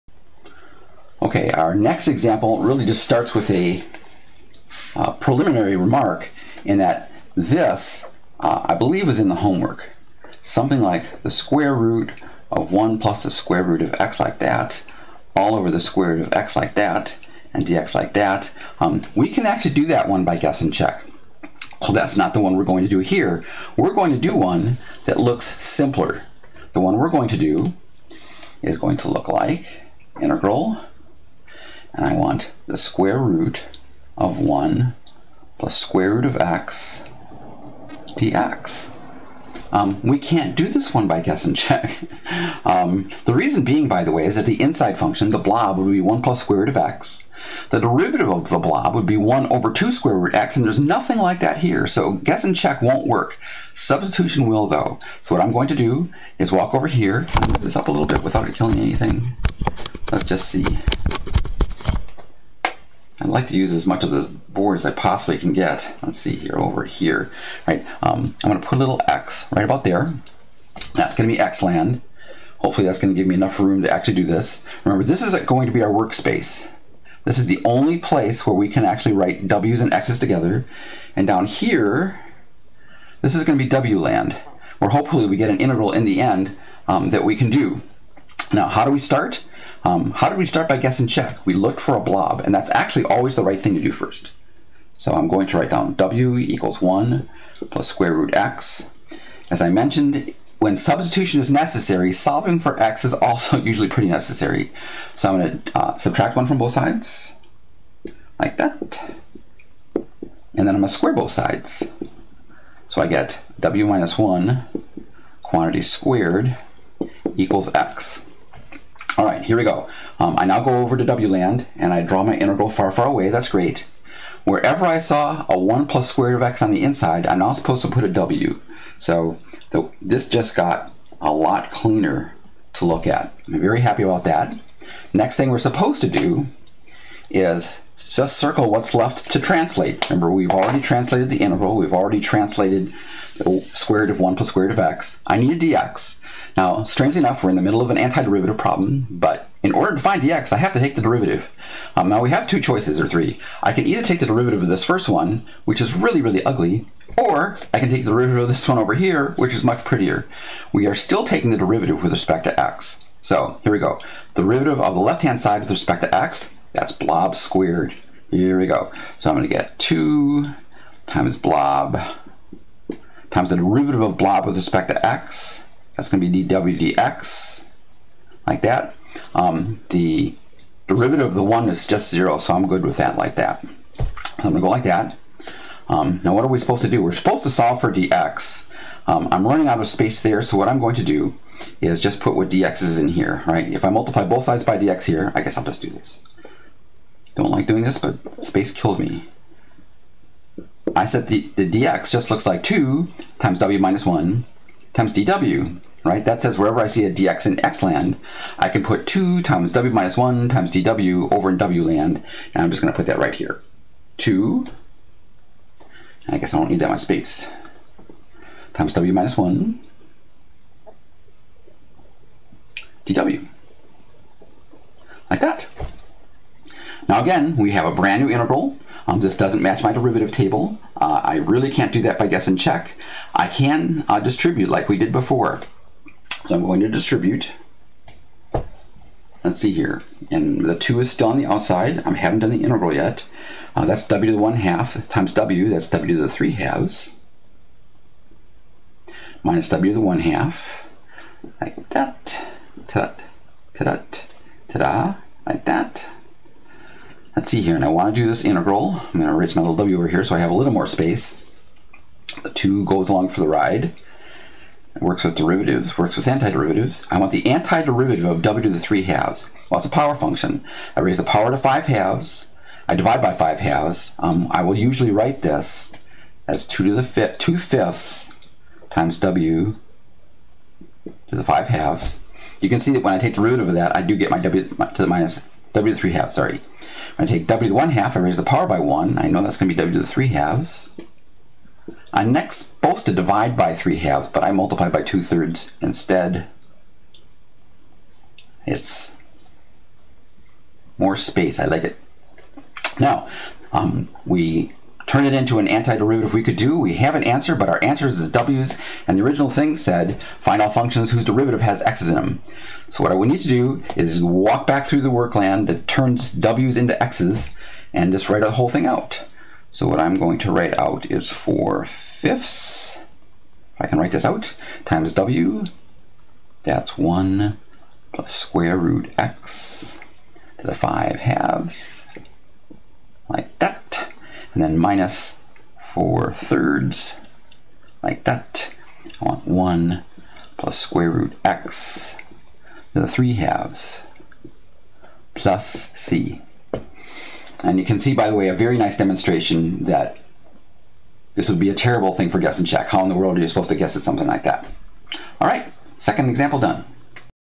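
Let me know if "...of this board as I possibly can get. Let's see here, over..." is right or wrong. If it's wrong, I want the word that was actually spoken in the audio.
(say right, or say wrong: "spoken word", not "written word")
right.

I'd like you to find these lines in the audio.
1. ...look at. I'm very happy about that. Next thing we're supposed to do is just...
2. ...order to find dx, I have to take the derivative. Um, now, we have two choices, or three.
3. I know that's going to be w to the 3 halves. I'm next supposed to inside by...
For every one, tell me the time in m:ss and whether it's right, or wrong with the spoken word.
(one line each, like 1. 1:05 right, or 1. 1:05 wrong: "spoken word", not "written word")
1. 2:12 right
2. 2:29 right
3. 4:49 wrong: "divide", not "inside".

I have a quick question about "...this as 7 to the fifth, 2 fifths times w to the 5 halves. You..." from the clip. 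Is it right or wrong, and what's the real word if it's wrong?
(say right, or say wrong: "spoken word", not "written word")
wrong: "2", not "7".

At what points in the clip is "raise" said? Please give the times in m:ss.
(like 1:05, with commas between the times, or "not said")
4:30, 4:48.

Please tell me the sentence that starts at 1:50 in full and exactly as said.
And then I'm going to square both sides.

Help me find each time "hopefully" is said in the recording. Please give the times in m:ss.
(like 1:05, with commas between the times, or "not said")
1:12, 1:24.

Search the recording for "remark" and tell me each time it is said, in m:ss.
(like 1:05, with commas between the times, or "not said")
0:05.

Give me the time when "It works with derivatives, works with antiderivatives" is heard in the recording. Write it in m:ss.
4:24.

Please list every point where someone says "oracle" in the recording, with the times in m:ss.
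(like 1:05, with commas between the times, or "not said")
not said.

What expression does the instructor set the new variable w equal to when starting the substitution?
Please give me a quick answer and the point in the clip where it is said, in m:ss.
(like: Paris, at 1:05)
1 plus square root x, at 1:35.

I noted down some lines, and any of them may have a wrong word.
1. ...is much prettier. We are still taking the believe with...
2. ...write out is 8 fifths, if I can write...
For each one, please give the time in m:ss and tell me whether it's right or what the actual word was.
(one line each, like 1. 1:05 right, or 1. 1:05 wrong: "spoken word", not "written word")
1. 2:39 wrong: "derivative", not "believe"
2. 5:20 wrong: "4", not "8".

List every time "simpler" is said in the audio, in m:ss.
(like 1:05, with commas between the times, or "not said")
0:25.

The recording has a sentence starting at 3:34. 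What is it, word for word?
2, I guess I don't need that much space, times w minus 1 dw.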